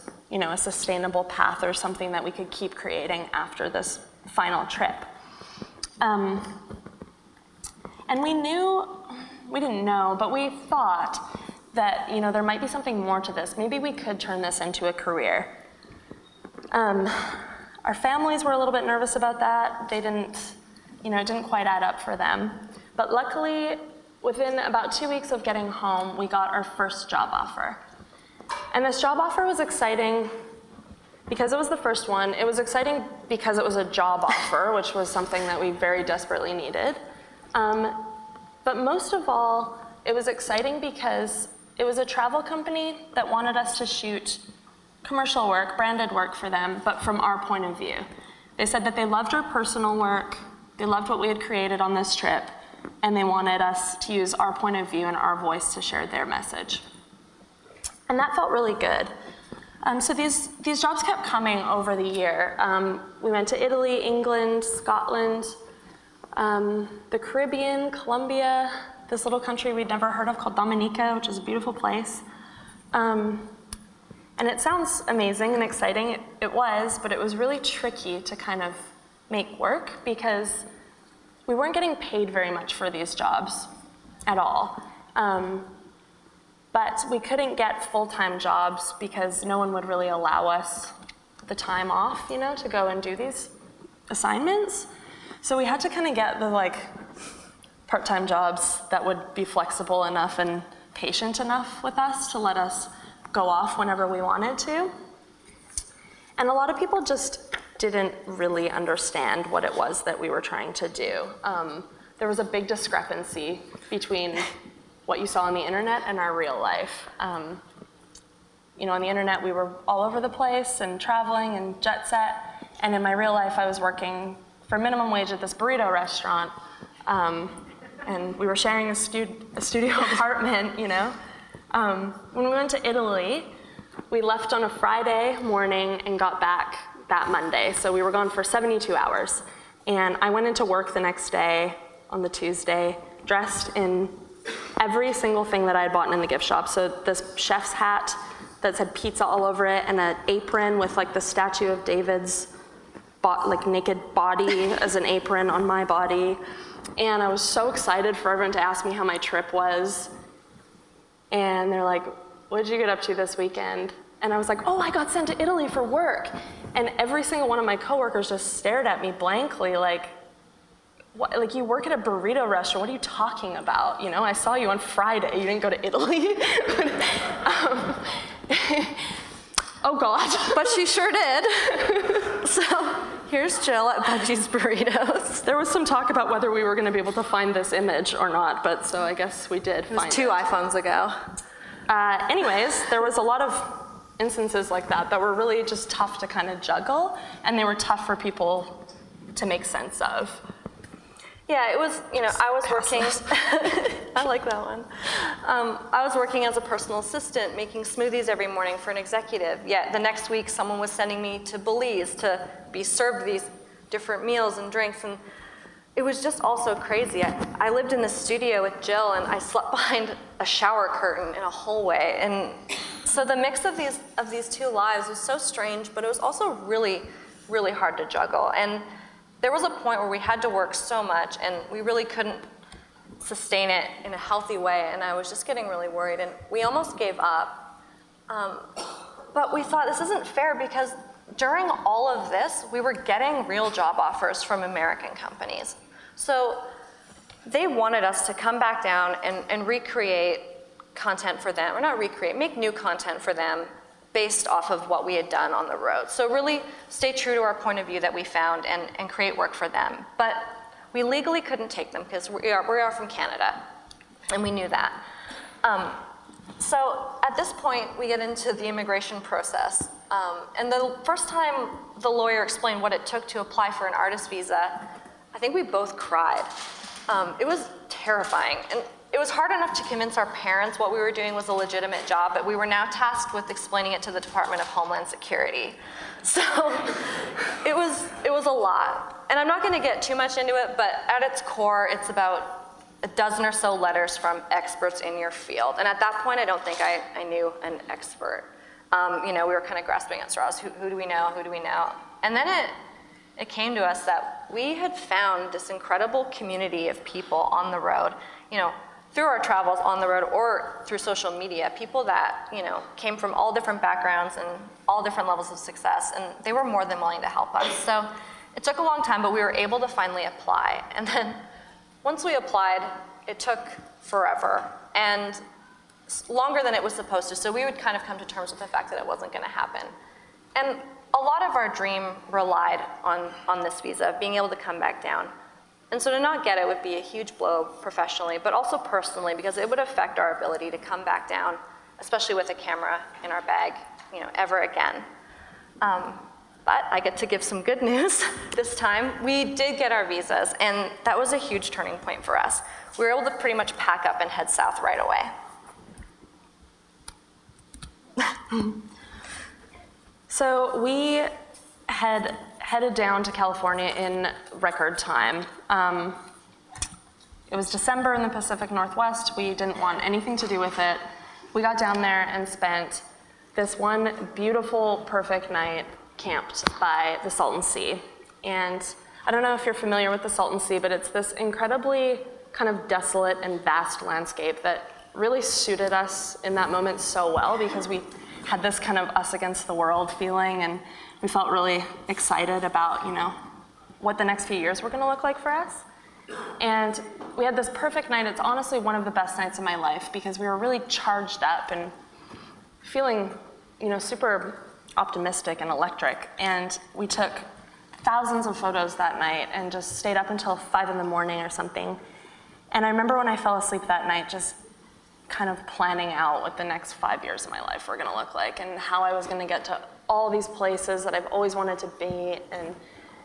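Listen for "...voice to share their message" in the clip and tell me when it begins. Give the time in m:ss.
0:55.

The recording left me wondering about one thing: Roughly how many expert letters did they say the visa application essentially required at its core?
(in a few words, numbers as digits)
About a dozen.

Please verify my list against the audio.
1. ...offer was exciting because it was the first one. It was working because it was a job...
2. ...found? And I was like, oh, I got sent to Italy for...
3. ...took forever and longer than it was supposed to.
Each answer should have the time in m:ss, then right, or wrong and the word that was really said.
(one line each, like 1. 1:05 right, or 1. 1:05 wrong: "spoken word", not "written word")
1. 0:29 wrong: "exciting", not "working"
2. 2:43 wrong: "weekend", not "found"
3. 5:23 right.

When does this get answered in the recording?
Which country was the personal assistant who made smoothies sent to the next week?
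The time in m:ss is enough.
3:31.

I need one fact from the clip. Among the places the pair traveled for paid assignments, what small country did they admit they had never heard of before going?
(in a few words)
Dominica.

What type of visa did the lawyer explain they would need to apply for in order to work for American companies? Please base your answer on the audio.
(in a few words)
Artist visa.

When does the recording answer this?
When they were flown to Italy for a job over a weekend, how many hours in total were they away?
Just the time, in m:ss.
2:18.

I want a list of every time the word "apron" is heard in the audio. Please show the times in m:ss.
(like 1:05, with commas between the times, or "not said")
2:30, 2:35.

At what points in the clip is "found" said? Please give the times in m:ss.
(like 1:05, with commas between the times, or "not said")
4:18, 5:04.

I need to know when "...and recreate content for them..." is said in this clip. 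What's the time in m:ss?
4:09.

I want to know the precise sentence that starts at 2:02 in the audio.
And in my real life, I was working for minimum wage at this burrito restaurant.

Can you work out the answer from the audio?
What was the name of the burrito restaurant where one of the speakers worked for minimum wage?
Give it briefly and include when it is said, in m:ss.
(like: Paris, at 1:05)
Budgie's Burritos, at 3:04.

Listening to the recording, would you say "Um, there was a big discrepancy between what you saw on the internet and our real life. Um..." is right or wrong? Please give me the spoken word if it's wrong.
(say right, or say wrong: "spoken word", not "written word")
right.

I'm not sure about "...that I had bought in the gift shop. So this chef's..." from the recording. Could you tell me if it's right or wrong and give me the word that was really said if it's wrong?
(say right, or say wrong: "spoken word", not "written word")
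right.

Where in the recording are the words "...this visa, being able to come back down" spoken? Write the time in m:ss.
5:33.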